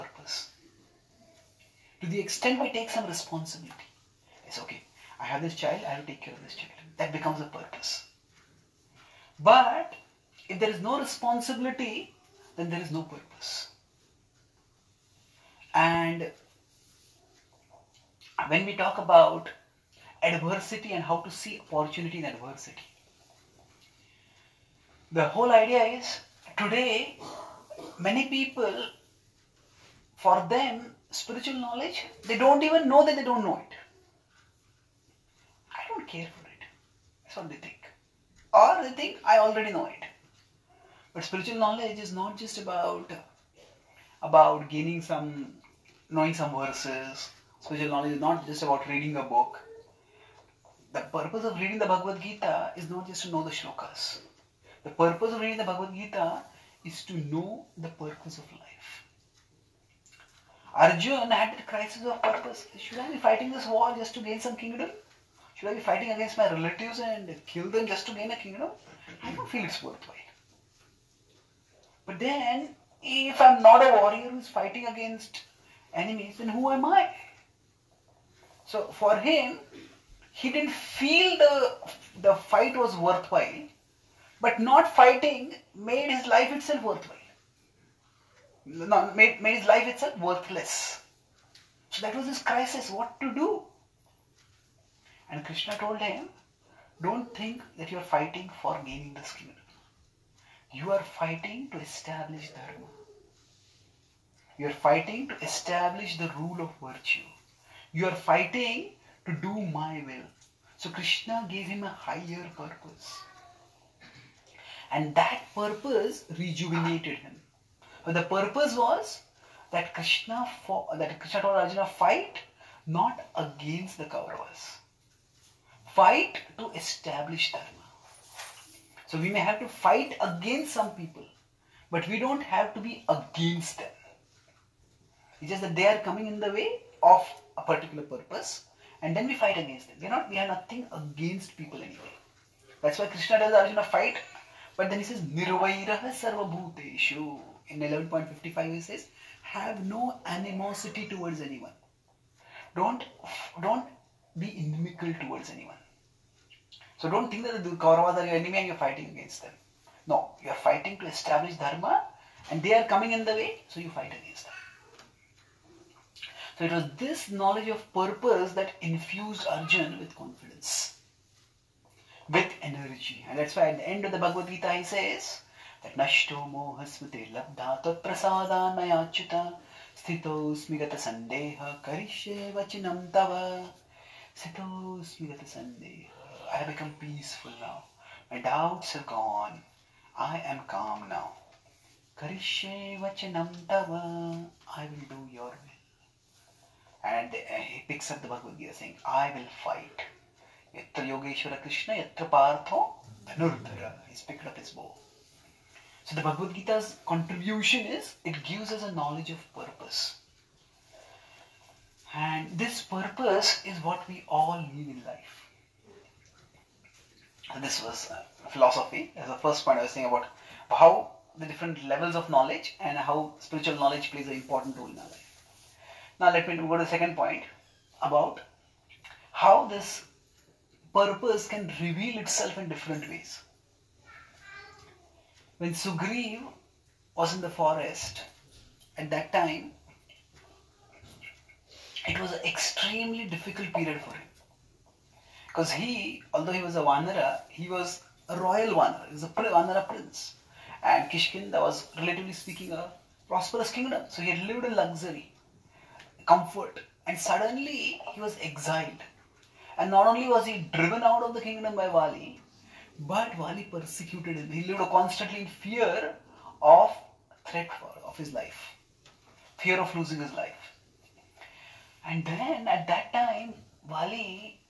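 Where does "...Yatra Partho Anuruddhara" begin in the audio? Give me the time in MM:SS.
03:21.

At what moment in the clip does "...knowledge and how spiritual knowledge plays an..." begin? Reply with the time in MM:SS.
03:42.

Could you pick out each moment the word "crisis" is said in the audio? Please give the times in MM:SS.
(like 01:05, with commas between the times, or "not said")
01:01, 01:32.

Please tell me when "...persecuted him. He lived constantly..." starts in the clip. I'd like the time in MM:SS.
04:23.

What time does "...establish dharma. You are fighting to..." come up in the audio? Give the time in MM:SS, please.
01:41.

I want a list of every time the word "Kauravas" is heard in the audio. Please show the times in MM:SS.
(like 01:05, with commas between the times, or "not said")
02:04, 02:37.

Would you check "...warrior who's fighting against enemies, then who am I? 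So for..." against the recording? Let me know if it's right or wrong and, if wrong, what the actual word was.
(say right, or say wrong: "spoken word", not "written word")
right.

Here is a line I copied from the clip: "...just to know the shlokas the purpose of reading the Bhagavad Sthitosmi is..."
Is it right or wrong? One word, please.
wrong.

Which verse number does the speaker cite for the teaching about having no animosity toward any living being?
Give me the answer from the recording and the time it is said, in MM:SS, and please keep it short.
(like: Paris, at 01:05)
11.55, at 02:27.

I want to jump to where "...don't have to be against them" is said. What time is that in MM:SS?
02:12.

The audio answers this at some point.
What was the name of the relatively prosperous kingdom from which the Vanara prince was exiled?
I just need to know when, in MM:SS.
04:11.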